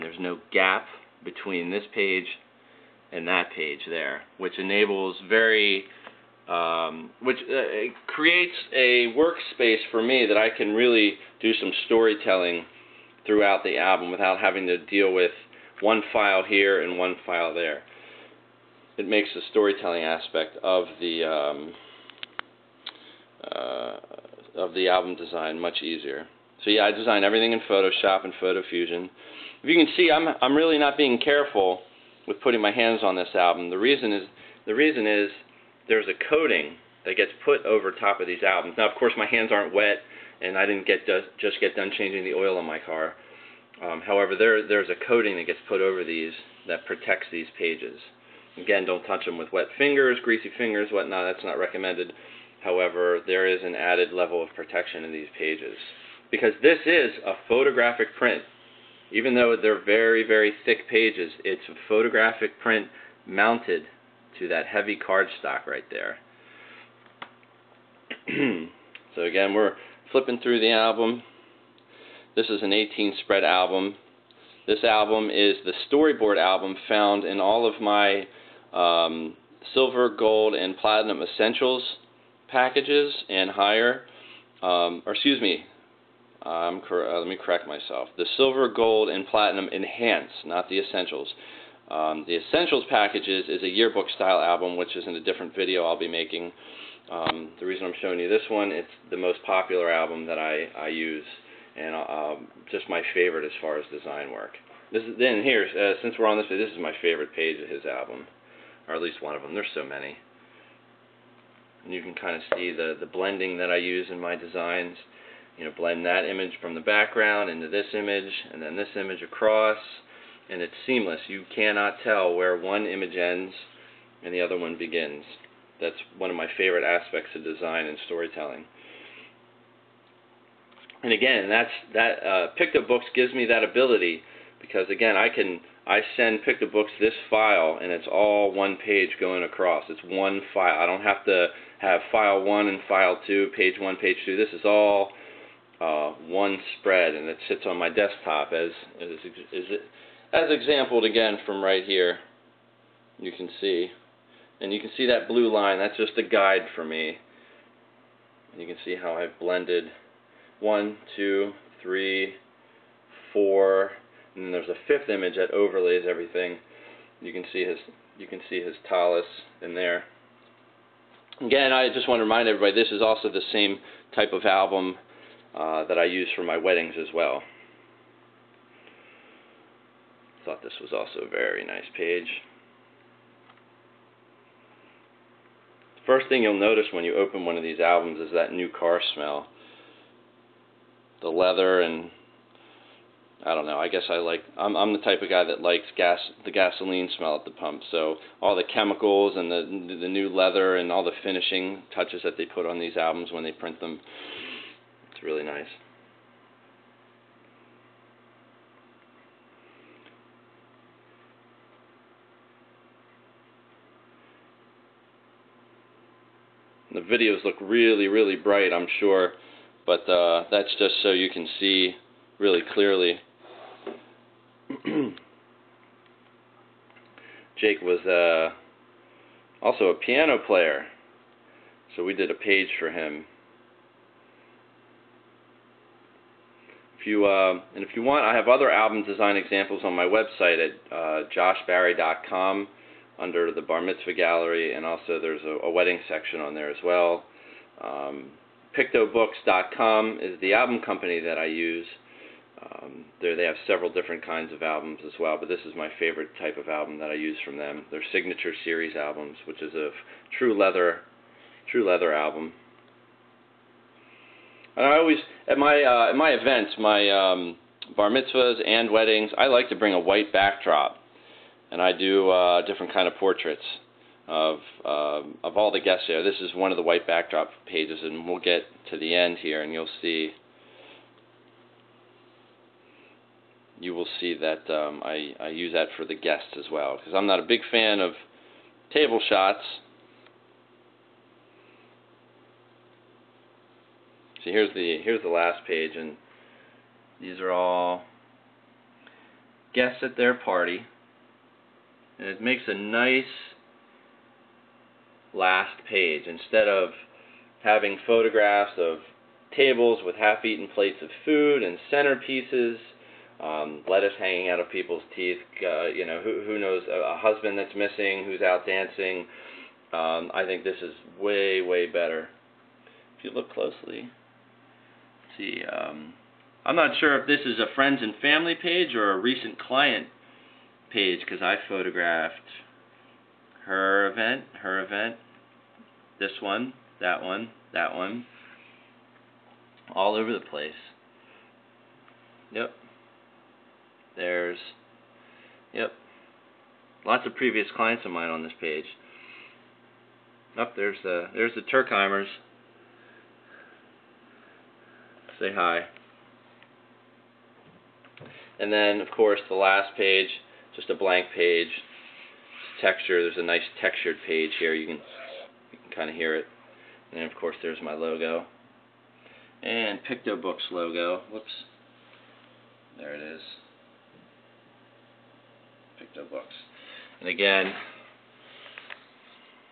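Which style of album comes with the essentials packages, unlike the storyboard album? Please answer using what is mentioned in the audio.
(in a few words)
Yearbook style.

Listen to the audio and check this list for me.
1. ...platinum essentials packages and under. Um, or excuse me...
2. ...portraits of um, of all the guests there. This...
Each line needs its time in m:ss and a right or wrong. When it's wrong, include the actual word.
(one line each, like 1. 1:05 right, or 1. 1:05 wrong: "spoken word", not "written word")
1. 1:20 wrong: "higher", not "under"
2. 4:33 right.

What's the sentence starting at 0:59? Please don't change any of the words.
Even though they're very, very thick pages, it's a photographic print mounted to that heavy cardstock right there.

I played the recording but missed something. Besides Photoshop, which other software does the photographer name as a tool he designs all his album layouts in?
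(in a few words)
Photo Fusion.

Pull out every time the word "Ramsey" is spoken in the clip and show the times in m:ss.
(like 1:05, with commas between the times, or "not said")
not said.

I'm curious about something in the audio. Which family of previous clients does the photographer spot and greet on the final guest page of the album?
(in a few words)
The Turkheimers.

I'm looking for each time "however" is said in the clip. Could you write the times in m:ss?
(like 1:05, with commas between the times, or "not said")
0:44, 0:52.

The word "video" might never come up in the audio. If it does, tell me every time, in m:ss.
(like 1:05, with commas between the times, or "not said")
1:35, 3:37.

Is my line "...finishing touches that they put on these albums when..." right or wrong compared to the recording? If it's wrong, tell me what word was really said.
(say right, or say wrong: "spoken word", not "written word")
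right.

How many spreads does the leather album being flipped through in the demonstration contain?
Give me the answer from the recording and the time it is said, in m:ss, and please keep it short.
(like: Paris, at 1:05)
18, at 1:12.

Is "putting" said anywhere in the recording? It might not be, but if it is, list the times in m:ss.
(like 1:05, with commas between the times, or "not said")
0:32.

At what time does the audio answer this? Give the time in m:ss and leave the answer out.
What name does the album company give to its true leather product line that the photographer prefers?
4:18.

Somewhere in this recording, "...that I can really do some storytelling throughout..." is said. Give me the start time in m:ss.
0:10.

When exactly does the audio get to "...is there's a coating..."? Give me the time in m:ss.
0:35.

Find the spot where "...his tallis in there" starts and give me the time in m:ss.
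2:48.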